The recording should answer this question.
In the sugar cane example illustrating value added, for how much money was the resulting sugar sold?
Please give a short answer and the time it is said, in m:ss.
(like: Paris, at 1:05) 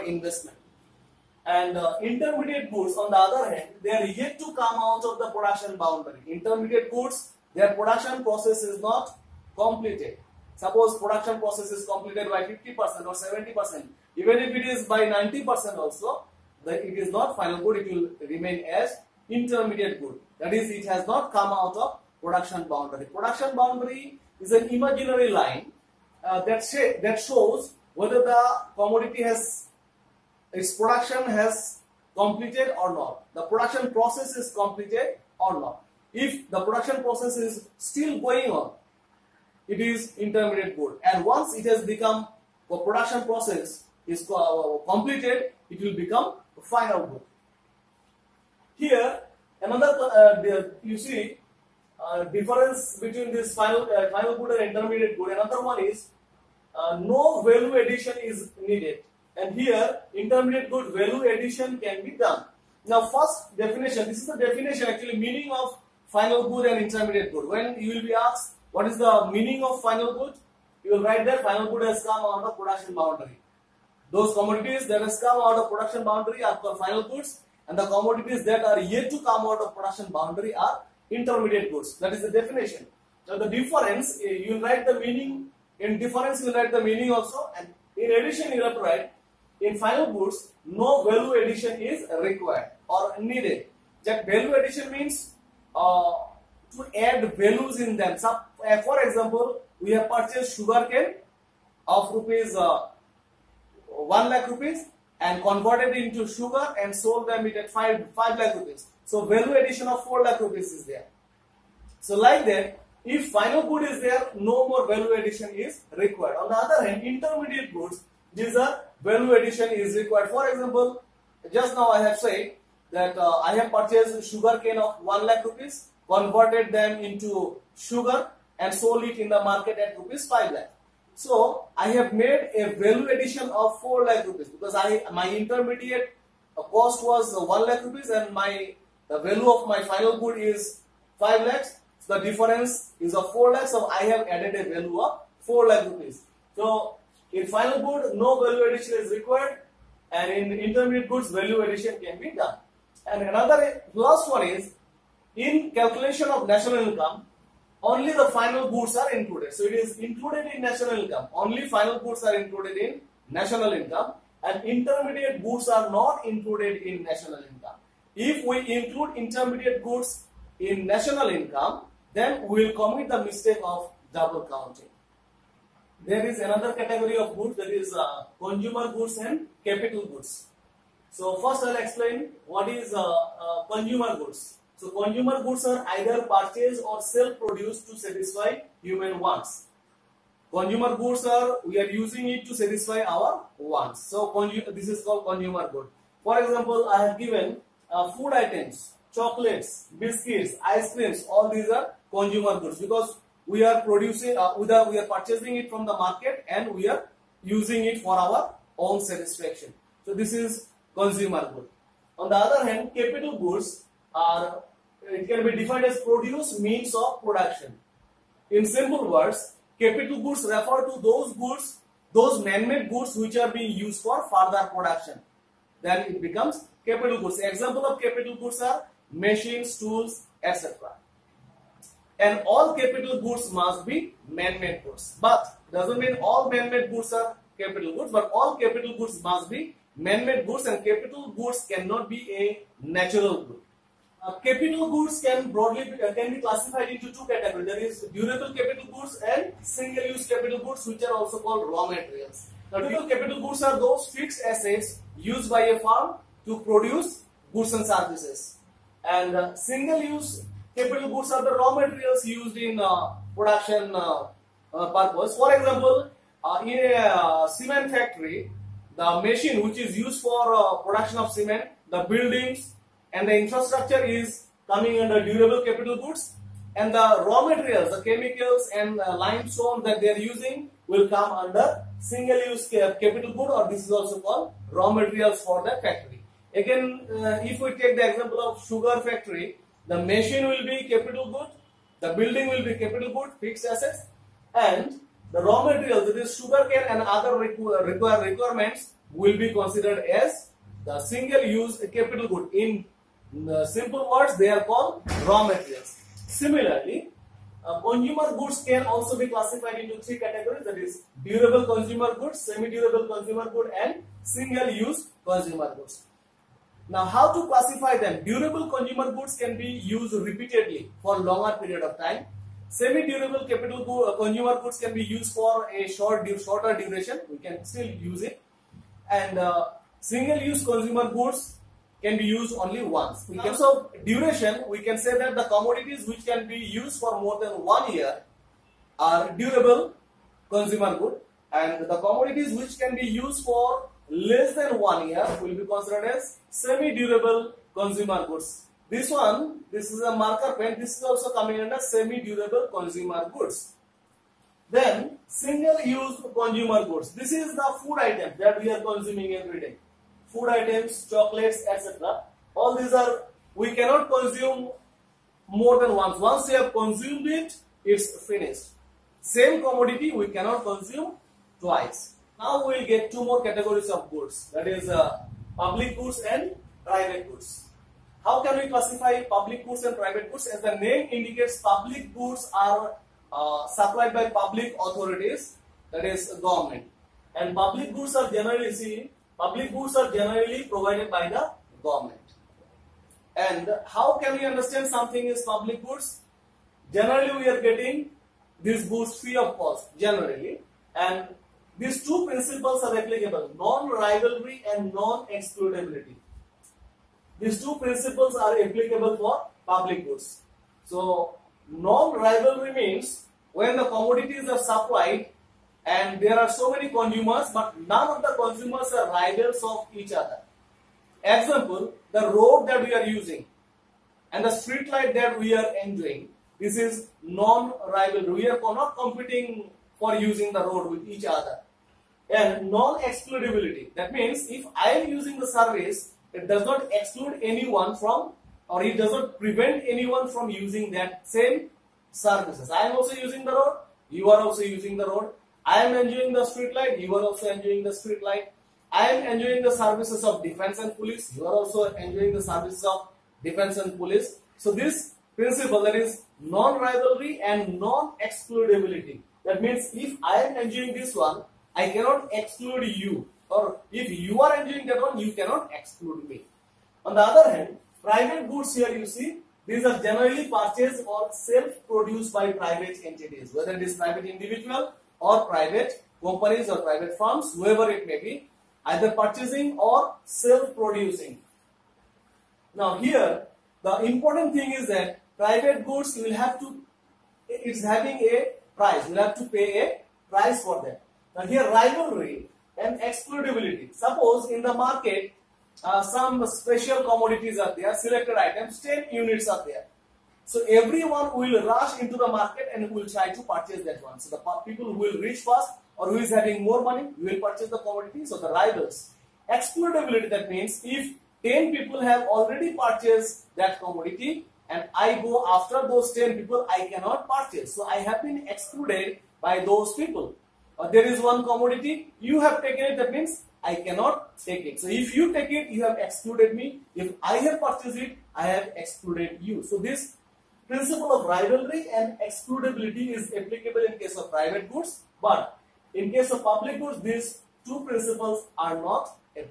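5 lakh rupees, at 2:08.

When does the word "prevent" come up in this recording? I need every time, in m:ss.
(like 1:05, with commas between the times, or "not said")
7:19.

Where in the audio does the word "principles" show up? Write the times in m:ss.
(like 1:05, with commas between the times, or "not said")
6:42, 6:47, 7:35, 8:50, 8:57.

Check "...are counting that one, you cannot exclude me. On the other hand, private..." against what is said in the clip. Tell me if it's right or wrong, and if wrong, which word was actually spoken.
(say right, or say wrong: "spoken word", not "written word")
wrong: "entering", not "counting".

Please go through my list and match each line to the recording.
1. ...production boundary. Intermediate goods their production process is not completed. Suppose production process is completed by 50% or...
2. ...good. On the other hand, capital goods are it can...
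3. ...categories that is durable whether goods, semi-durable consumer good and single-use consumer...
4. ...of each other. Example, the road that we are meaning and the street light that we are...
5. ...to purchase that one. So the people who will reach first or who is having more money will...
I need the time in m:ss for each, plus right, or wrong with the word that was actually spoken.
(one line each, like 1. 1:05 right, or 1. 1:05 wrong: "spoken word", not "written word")
1. 0:05 right
2. 3:31 right
3. 5:10 wrong: "consumer", not "whether"
4. 6:59 wrong: "using", not "meaning"
5. 8:23 right.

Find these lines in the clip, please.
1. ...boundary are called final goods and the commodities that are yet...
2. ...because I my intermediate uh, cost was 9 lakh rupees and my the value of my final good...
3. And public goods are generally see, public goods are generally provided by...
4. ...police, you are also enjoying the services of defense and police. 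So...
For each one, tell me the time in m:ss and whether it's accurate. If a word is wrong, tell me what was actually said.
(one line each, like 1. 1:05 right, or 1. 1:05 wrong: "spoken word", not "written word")
1. 1:16 right
2. 2:14 wrong: "1", not "9"
3. 6:27 right
4. 7:30 right.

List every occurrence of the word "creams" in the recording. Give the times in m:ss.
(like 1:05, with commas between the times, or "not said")
3:20.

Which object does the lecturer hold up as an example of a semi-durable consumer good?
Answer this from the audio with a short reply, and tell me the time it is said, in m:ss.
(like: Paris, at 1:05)
marker pen, at 5:49.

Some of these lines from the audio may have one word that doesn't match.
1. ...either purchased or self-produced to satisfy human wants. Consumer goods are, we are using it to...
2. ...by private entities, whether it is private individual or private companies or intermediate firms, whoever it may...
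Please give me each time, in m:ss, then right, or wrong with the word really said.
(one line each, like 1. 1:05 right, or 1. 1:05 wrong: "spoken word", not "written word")
1. 3:05 right
2. 7:52 wrong: "private", not "intermediate".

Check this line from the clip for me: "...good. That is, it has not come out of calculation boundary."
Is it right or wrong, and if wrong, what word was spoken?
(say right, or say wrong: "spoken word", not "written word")
wrong: "production", not "calculation".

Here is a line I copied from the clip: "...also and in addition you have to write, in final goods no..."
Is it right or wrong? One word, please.
right.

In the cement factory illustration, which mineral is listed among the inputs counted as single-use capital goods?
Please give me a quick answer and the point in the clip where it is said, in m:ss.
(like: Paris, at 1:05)
limestone, at 4:39.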